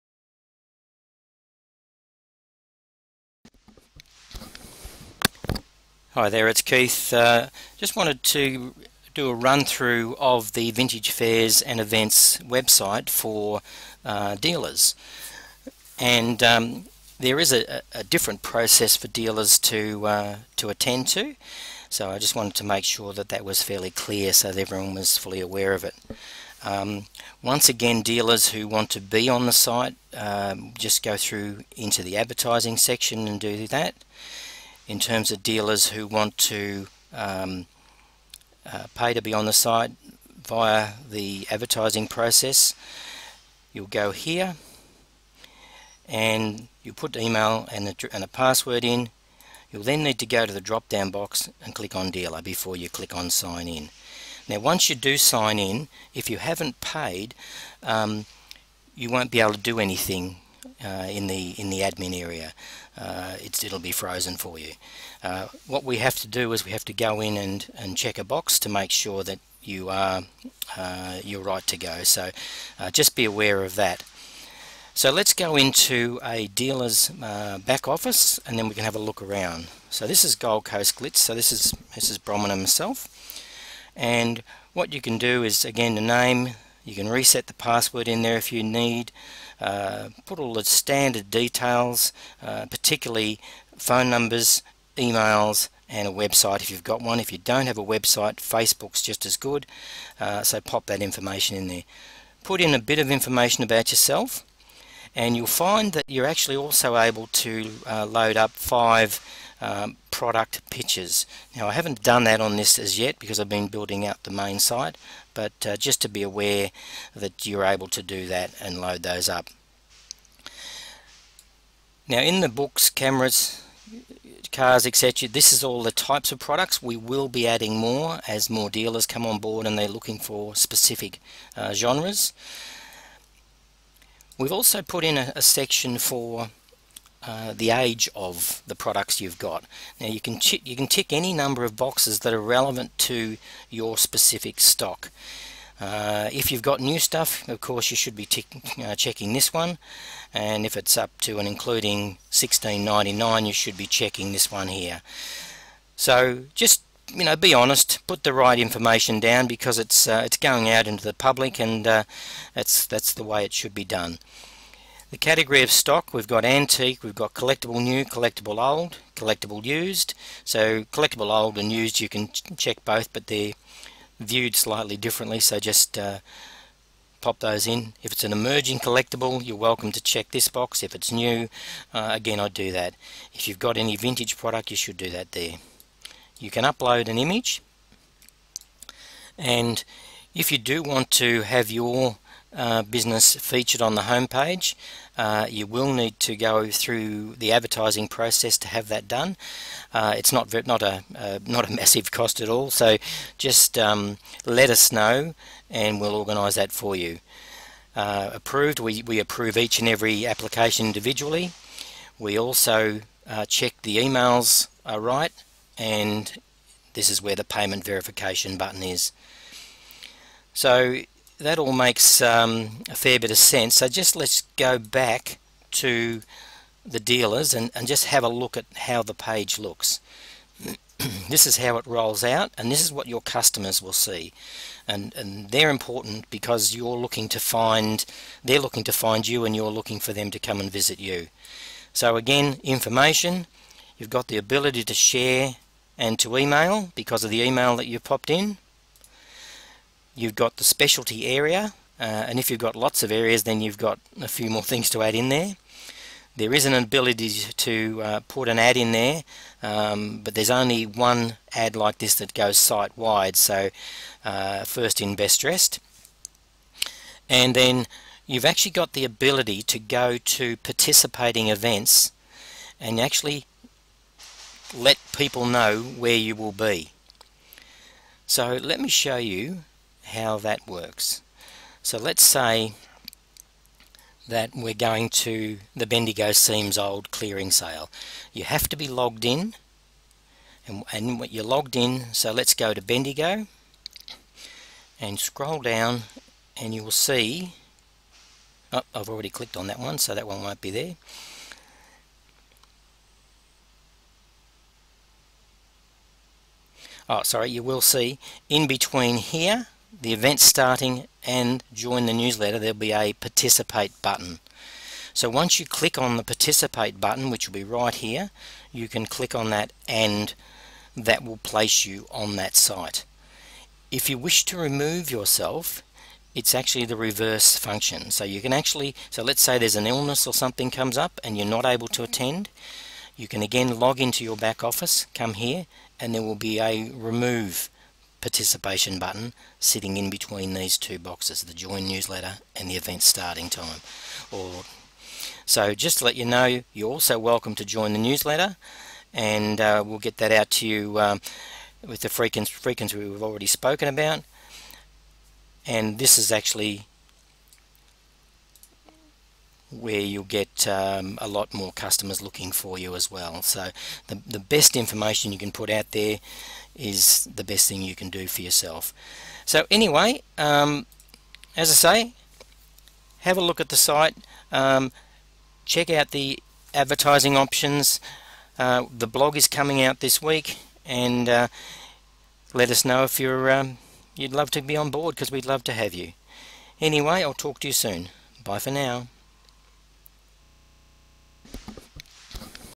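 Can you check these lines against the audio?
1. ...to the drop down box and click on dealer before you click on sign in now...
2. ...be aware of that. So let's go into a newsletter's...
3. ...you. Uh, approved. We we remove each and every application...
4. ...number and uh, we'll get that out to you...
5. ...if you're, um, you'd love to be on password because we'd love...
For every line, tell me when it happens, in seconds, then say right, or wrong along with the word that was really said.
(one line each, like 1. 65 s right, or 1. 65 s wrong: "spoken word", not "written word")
1. 50 s right
2. 73 s wrong: "dealer", not "newsletter"
3. 206 s wrong: "approve", not "remove"
4. 347 s wrong: "newsletter", not "number"
5. 383 s wrong: "board", not "password".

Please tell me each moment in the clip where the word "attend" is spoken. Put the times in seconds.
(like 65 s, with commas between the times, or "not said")
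20 s, 332 s.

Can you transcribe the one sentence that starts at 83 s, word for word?
And what you can do is again the name you can reset the password in there if you need.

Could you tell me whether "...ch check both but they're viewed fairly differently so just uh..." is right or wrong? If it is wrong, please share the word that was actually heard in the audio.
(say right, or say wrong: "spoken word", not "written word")
wrong: "slightly", not "fairly".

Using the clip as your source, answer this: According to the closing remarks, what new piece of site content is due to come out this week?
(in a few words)
The blog.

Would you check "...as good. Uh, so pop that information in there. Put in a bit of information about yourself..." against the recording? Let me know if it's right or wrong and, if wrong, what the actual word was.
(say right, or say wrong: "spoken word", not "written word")
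right.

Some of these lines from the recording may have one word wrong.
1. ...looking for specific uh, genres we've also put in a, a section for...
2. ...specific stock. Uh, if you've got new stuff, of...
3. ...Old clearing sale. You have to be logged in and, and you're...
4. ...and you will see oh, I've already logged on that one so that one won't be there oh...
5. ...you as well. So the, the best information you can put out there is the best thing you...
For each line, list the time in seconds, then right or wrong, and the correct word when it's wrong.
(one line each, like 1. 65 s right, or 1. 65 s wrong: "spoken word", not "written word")
1. 129 s right
2. 143 s right
3. 286 s right
4. 296 s wrong: "clicked", not "logged"
5. 362 s right.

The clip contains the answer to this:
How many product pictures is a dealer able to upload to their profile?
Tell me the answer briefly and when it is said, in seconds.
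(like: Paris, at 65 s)
5, at 108 s.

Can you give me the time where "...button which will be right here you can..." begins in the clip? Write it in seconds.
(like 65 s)
317 s.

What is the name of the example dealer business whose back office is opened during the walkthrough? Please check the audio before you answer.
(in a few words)
Gold Coast Glitz.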